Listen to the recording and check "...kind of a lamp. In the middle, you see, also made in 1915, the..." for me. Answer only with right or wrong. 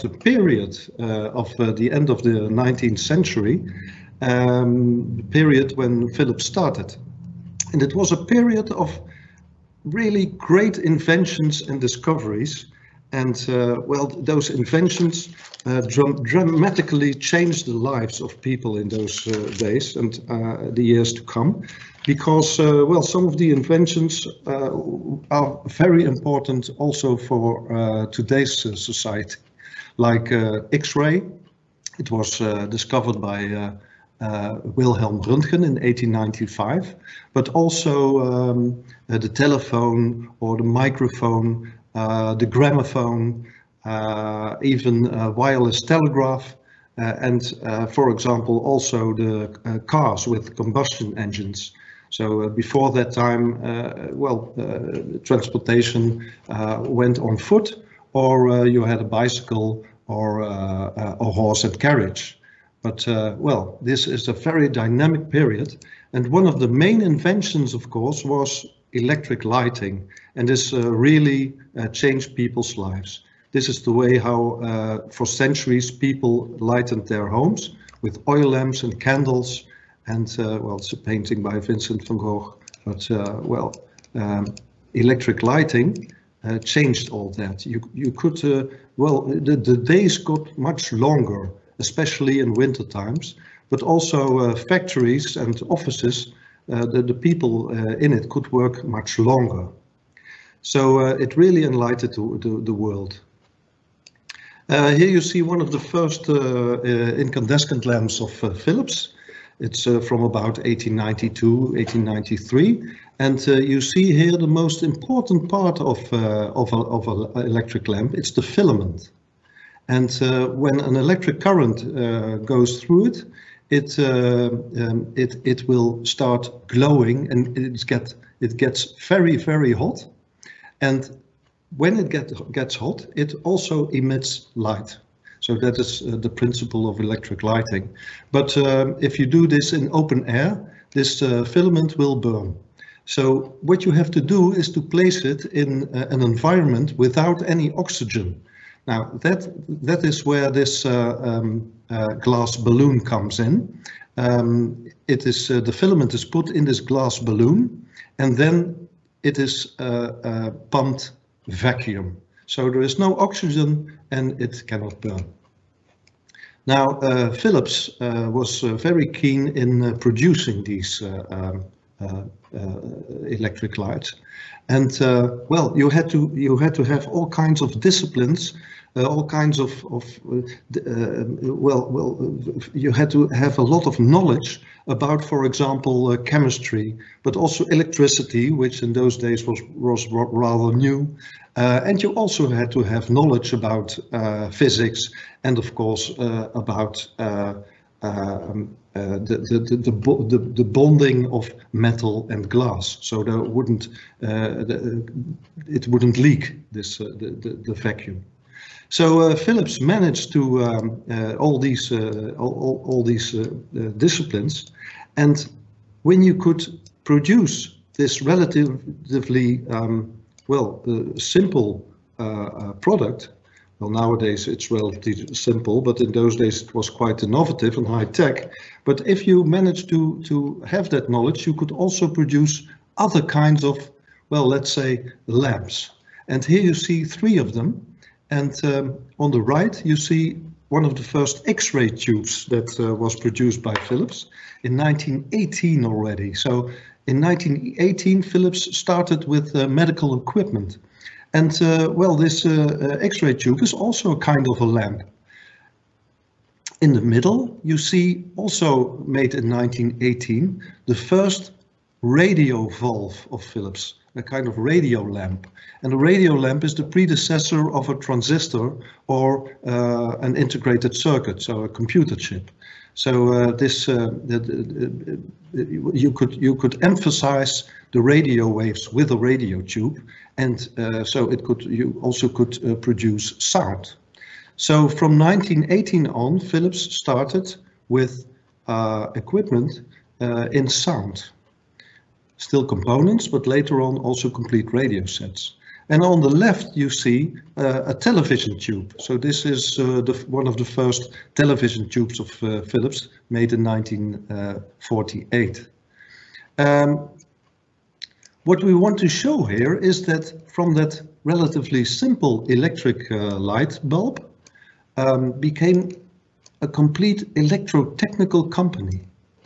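wrong.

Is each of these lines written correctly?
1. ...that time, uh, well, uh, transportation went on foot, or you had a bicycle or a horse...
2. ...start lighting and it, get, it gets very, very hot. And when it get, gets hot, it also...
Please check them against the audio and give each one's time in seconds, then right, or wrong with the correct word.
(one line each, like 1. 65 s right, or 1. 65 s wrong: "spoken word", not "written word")
1. 52 s right
2. 126 s wrong: "glowing", not "lighting".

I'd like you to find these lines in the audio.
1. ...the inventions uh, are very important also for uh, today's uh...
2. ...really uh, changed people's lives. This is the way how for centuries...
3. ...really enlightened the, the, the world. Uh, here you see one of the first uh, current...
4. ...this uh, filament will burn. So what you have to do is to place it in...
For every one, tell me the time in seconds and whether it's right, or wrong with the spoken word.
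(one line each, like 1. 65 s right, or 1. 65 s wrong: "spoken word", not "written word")
1. 23 s right
2. 70 s right
3. 101 s wrong: "incandescent", not "current"
4. 140 s right.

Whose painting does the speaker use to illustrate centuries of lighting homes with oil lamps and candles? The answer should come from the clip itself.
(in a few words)
Vincent van Gogh.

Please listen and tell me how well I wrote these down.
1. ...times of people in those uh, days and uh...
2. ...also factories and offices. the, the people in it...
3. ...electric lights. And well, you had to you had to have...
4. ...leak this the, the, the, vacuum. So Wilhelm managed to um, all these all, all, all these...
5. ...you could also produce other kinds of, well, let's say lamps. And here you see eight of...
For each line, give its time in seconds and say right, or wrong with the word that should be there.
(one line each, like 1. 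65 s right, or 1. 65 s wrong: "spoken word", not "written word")
1. 17 s wrong: "lives", not "times"
2. 93 s right
3. 173 s right
4. 206 s wrong: "Philips", not "Wilhelm"
5. 231 s wrong: "three", not "eight".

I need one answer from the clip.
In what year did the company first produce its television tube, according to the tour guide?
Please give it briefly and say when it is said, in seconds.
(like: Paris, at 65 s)
1948, at 303 s.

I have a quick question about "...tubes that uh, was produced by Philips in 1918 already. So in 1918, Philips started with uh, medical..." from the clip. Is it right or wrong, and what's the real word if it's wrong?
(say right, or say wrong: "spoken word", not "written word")
right.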